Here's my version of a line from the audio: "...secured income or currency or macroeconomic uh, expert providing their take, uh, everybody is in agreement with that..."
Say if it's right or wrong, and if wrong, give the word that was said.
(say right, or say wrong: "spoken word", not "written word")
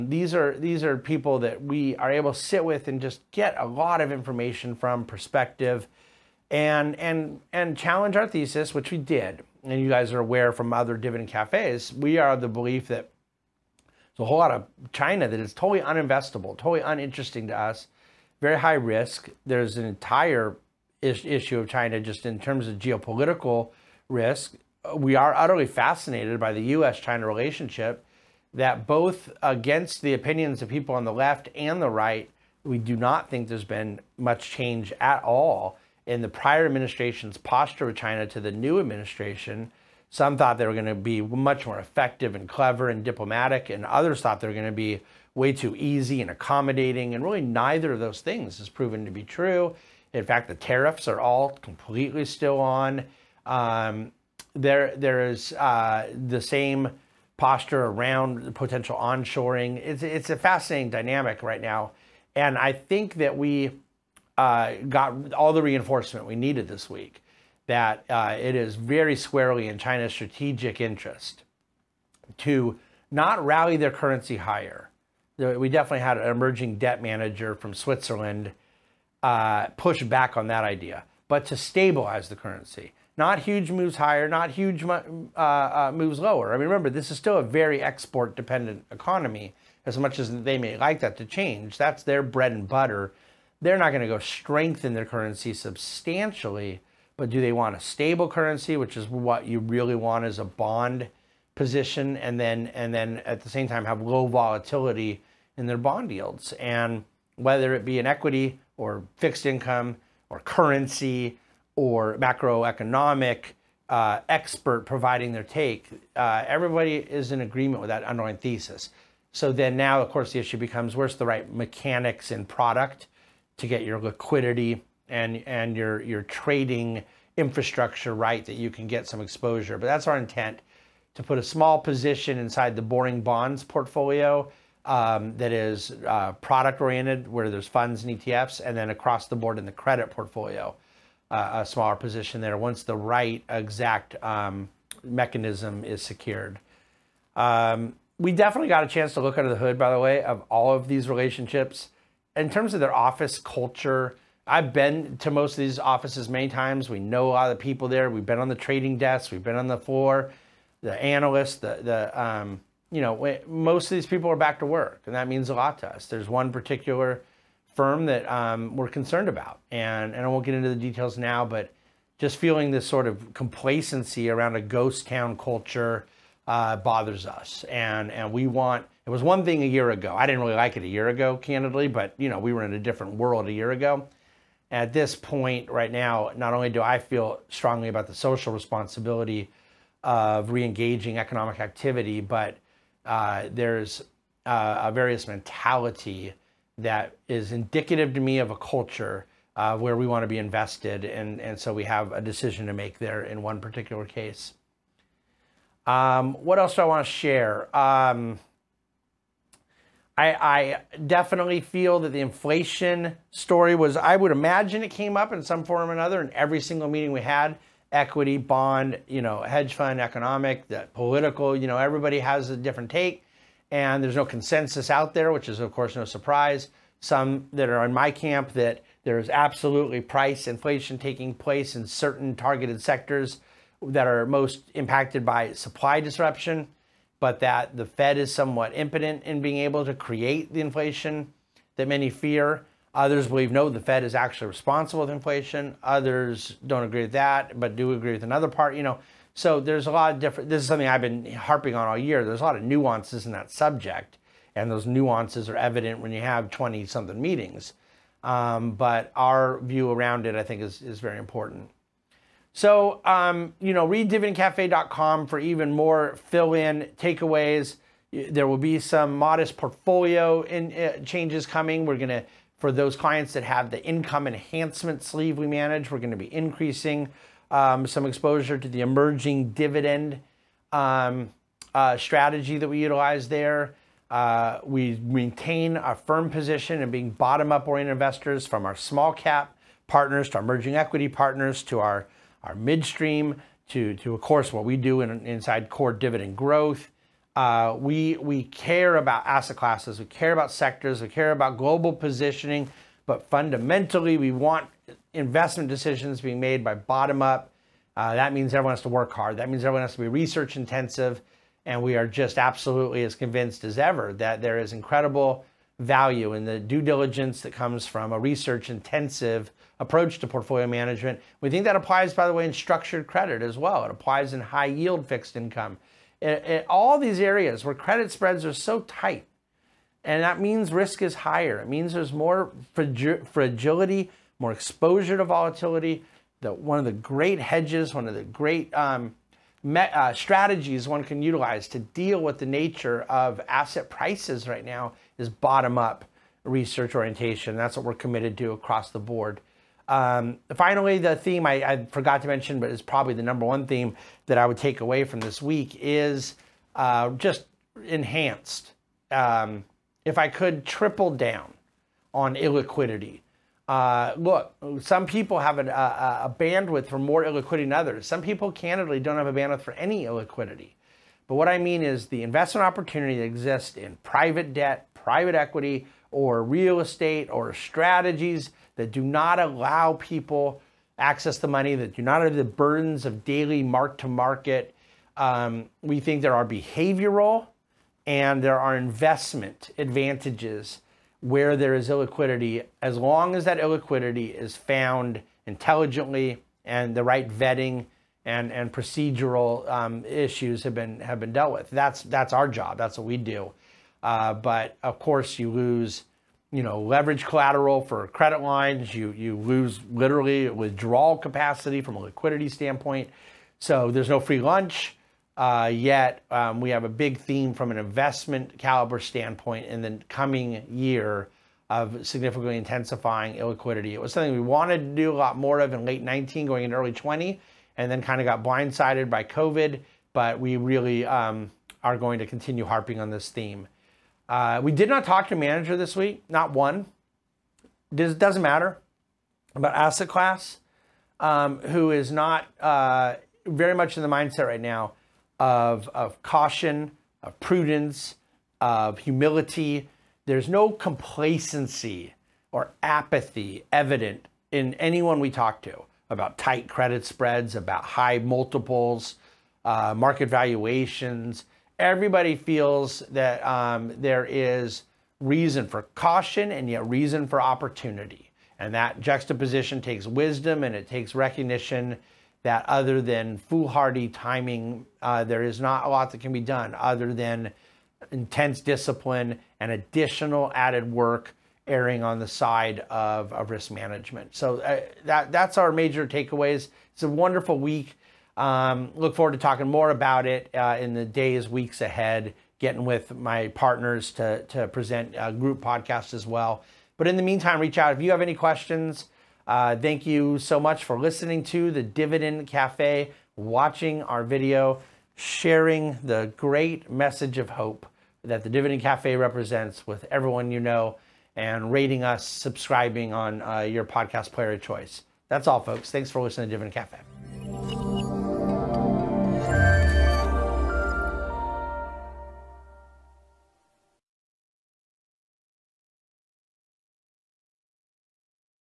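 wrong: "fixed", not "secured".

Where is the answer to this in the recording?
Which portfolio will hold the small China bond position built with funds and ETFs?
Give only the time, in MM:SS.
02:12.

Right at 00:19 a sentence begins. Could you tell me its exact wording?
There's an entire is issue of China just in terms of geopolitical risk.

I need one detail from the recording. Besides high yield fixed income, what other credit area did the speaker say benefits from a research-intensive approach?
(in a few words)
structured credit.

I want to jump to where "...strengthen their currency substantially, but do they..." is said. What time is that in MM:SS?
01:34.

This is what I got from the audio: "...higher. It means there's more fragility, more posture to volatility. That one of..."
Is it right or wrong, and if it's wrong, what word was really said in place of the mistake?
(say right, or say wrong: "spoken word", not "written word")
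wrong: "exposure", not "posture".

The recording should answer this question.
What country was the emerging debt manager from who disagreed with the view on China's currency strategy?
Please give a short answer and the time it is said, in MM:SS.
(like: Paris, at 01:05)
Switzerland, at 01:17.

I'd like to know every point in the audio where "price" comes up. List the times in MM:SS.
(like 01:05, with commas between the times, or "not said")
03:50, 05:43.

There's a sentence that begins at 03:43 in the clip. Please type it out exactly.
And there's no consensus out there, which is, of course, no surprise.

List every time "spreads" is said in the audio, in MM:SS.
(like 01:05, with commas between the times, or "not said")
05:28, 07:37.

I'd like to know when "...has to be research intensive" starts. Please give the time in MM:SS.
05:09.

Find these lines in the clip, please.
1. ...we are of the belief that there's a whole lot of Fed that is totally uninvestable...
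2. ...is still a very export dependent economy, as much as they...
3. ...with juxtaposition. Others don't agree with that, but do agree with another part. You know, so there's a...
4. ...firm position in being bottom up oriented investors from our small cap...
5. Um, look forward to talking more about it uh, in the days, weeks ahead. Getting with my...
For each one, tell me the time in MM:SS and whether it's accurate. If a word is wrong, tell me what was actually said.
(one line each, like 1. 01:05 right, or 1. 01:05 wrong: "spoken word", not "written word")
1. 00:11 wrong: "China", not "Fed"
2. 01:27 right
3. 04:05 wrong: "inflation", not "juxtaposition"
4. 04:45 right
5. 08:08 right.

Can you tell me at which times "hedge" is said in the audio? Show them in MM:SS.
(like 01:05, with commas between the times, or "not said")
03:39, 05:37.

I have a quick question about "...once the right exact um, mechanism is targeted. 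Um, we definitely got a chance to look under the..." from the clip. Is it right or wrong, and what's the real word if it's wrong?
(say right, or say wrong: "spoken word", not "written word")
wrong: "secured", not "targeted".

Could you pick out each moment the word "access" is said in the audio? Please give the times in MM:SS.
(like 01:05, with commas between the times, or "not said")
06:20.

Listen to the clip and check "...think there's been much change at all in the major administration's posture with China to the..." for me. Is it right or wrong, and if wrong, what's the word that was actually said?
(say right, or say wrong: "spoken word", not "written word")
wrong: "prior", not "major".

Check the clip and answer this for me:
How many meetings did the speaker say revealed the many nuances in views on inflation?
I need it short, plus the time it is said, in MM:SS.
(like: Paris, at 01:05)
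20 something, at 04:16.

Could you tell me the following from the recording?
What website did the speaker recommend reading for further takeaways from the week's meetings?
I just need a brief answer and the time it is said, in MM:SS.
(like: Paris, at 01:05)
dividendcafe.com, at 04:24.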